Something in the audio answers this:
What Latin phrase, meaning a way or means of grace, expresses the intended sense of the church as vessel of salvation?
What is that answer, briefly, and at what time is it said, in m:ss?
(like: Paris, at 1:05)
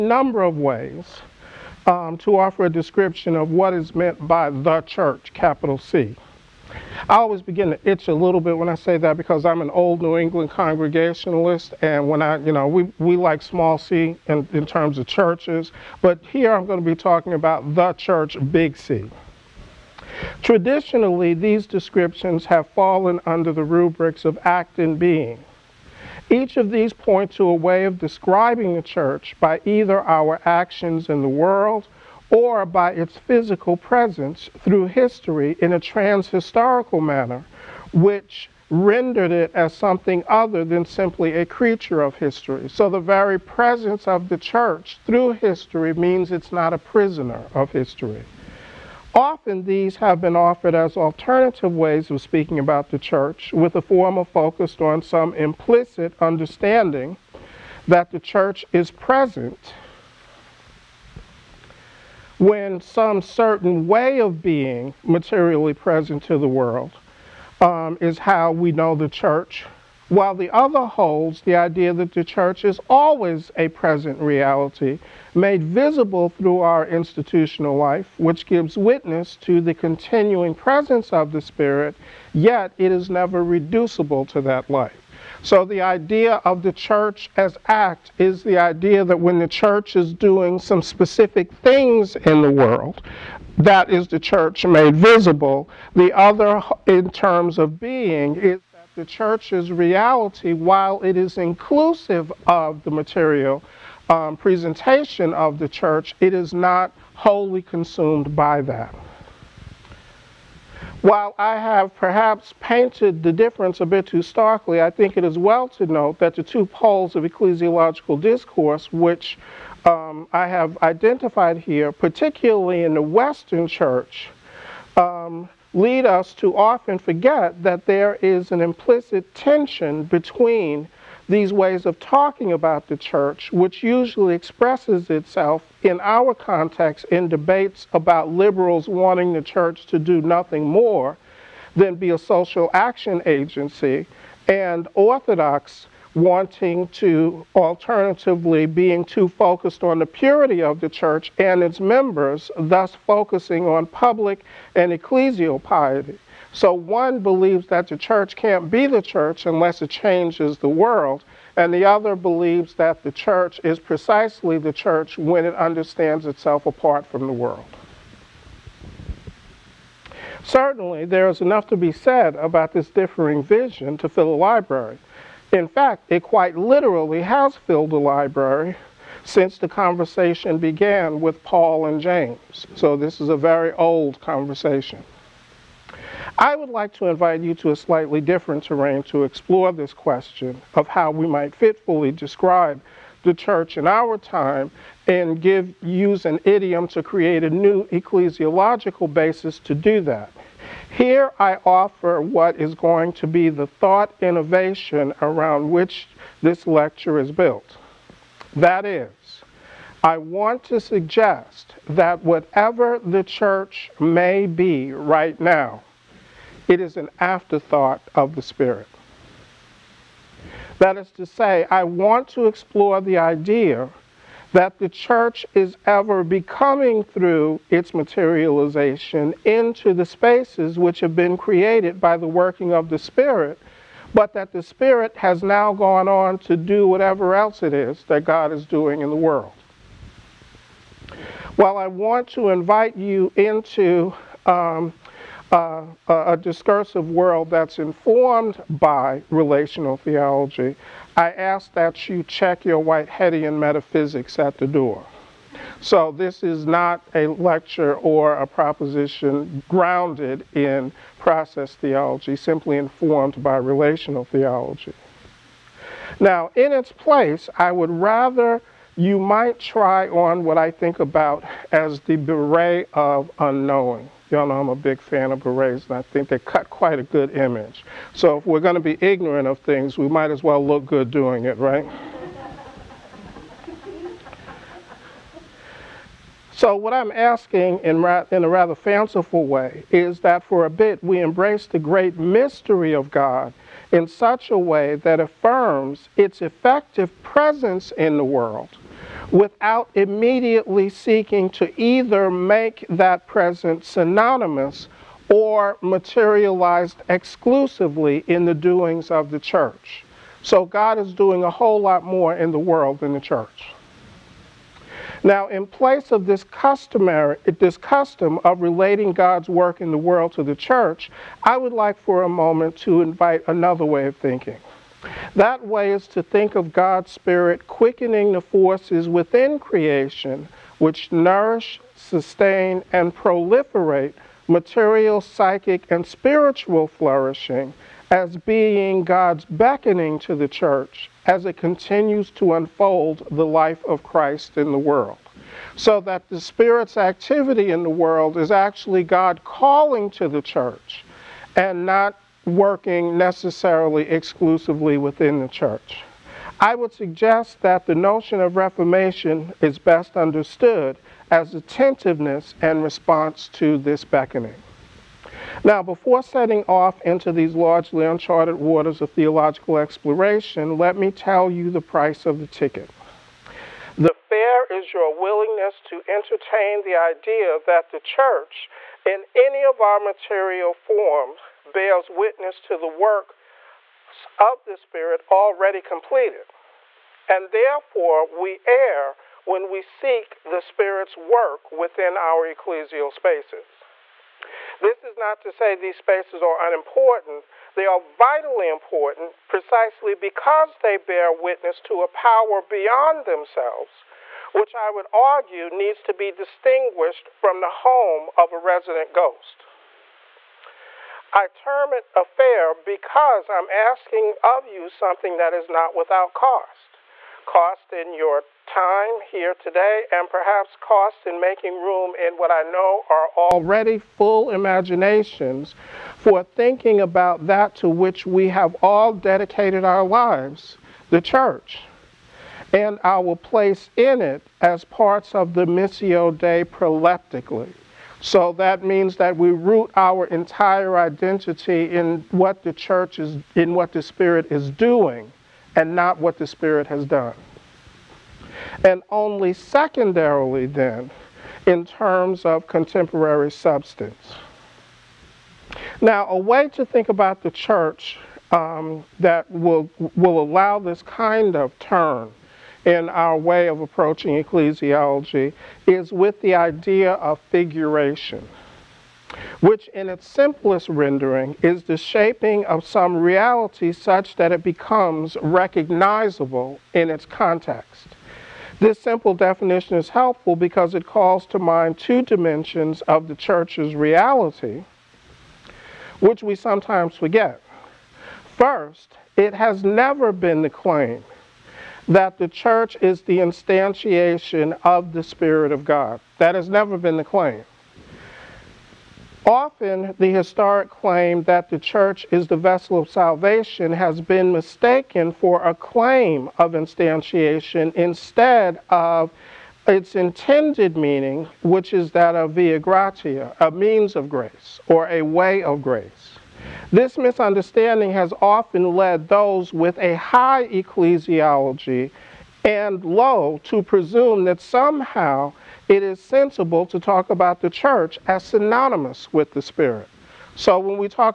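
via gratia, at 8:32.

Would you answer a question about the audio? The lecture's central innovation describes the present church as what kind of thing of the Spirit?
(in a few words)
an afterthought.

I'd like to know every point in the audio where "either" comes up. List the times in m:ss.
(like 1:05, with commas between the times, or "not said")
0:29, 5:01.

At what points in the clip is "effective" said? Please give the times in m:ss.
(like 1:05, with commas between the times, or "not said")
4:56.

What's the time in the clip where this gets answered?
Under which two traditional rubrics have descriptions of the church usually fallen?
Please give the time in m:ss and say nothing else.
0:24.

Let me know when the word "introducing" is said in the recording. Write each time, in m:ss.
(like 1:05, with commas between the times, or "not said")
not said.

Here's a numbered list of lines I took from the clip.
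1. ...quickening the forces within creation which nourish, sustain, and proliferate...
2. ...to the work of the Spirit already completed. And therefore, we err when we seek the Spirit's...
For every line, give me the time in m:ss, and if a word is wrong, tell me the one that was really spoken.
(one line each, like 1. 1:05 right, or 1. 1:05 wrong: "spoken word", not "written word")
1. 5:27 right
2. 6:22 right.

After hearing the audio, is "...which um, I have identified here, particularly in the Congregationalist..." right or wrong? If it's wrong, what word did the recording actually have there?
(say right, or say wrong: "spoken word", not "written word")
wrong: "Western", not "Congregationalist".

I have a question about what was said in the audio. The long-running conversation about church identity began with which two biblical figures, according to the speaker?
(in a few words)
Paul and James.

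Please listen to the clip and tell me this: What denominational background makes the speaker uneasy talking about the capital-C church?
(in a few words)
New England Congregationalist.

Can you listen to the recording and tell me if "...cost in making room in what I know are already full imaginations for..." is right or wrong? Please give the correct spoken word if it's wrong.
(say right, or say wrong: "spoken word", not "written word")
right.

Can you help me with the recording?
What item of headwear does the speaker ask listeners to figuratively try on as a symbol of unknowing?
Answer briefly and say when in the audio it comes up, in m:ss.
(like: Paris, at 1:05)
beret, at 4:32.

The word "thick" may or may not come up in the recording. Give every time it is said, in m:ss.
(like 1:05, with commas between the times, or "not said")
not said.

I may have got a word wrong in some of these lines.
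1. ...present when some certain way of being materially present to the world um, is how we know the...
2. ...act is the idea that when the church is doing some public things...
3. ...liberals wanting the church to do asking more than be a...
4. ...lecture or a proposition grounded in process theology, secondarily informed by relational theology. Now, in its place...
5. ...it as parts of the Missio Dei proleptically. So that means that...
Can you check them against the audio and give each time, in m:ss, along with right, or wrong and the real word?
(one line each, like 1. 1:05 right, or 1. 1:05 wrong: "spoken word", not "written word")
1. 0:58 right
2. 1:27 wrong: "specific", not "public"
3. 2:18 wrong: "nothing", not "asking"
4. 4:17 wrong: "simply", not "secondarily"
5. 7:14 right.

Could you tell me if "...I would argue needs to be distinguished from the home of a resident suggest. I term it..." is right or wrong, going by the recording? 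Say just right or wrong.
wrong.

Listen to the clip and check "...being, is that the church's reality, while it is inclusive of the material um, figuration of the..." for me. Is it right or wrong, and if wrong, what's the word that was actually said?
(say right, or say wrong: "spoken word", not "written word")
wrong: "presentation", not "figuration".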